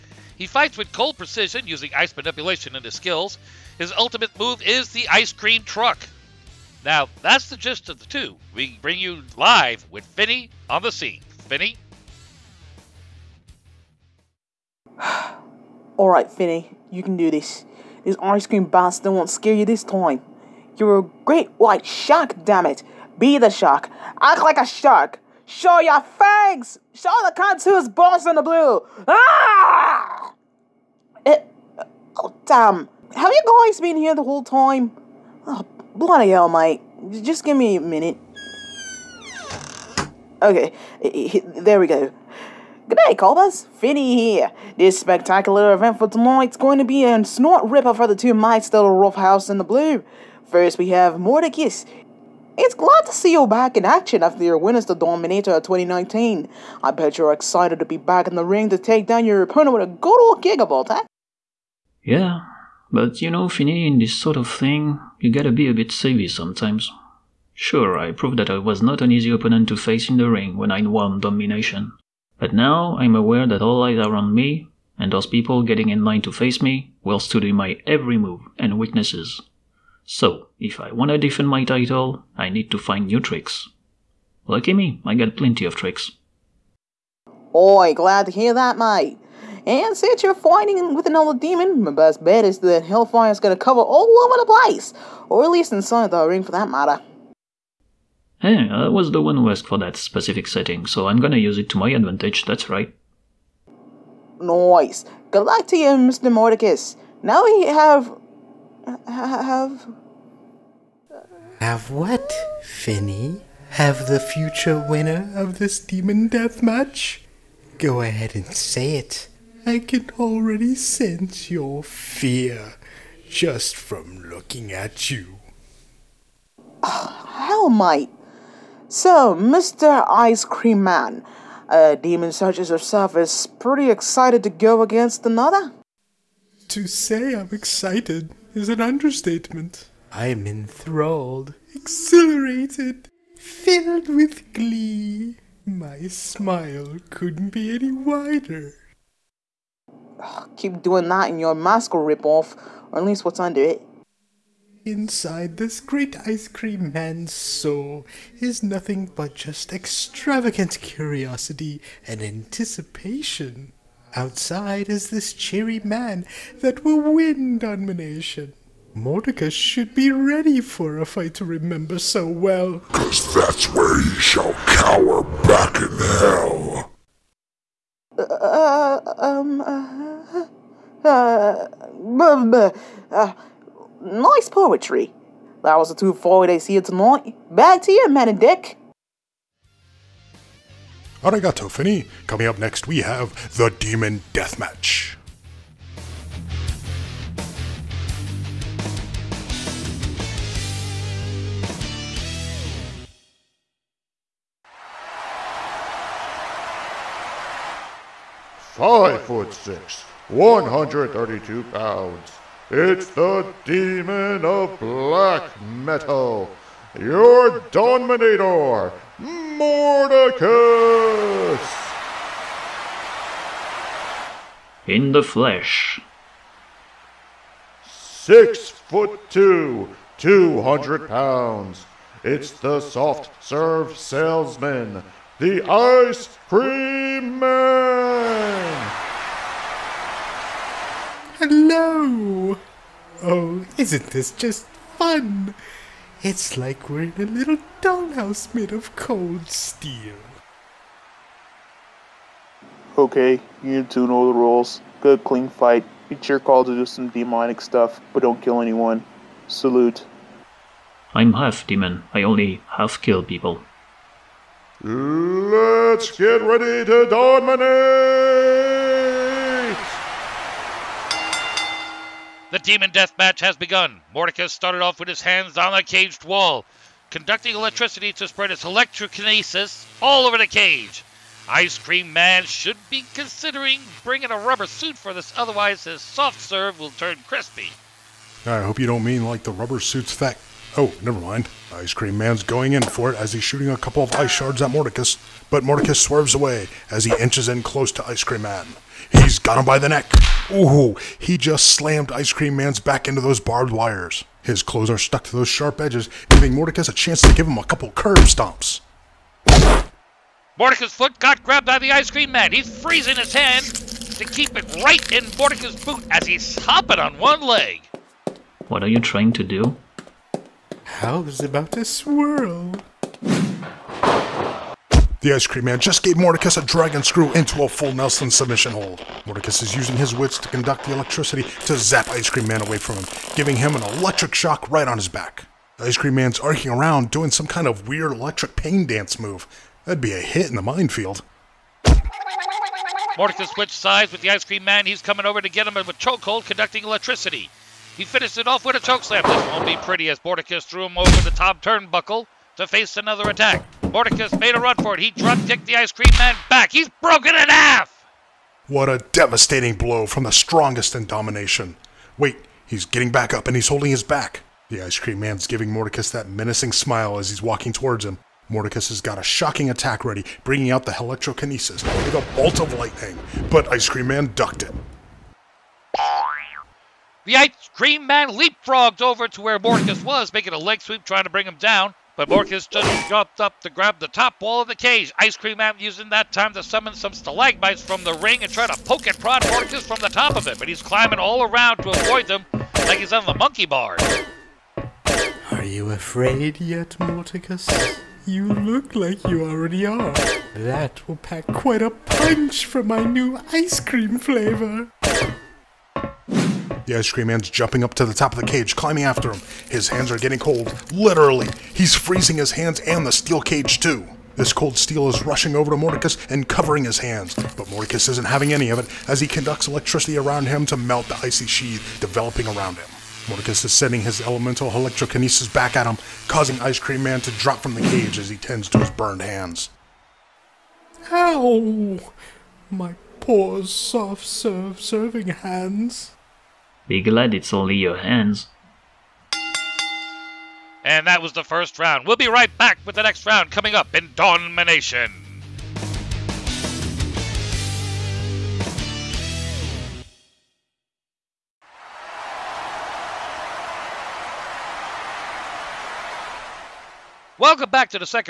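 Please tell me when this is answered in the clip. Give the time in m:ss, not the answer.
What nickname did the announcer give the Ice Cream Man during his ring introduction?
3:52.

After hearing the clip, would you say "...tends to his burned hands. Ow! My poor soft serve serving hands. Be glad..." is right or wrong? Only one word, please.
right.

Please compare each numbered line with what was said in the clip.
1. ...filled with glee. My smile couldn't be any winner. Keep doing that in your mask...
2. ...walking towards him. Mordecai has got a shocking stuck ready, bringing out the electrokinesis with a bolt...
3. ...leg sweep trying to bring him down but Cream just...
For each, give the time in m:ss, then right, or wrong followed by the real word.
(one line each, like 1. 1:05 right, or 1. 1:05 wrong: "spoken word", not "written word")
1. 2:23 wrong: "wider", not "winner"
2. 6:07 wrong: "attack", not "stuck"
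3. 6:20 wrong: "Morcus", not "Cream".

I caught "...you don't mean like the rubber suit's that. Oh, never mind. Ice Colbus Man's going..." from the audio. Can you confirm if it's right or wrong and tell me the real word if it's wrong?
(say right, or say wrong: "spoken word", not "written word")
wrong: "Cream", not "Colbus".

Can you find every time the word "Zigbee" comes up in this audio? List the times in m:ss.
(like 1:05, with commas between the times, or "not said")
not said.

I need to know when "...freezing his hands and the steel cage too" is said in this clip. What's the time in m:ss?
6:51.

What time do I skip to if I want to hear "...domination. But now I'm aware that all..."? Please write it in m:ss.
1:11.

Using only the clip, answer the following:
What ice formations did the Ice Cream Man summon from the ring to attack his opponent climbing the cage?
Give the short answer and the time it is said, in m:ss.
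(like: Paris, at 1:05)
Stalagmites, at 6:27.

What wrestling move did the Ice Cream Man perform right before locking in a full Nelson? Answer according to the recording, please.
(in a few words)
Dragon screw.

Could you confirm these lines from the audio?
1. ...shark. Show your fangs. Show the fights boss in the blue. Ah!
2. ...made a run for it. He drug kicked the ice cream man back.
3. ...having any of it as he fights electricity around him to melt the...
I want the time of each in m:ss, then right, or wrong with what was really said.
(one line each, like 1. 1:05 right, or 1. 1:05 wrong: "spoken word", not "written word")
1. 0:24 wrong: "cunts", not "fights"
2. 5:54 right
3. 6:58 wrong: "conducts", not "fights".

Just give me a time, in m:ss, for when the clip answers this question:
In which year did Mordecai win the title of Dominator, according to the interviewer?
0:55.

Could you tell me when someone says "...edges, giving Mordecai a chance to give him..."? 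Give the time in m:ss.
5:05.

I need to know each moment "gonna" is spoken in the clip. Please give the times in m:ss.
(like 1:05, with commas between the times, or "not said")
1:33, 1:41.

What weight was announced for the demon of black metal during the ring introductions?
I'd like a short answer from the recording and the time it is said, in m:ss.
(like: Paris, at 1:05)
132 pounds, at 3:30.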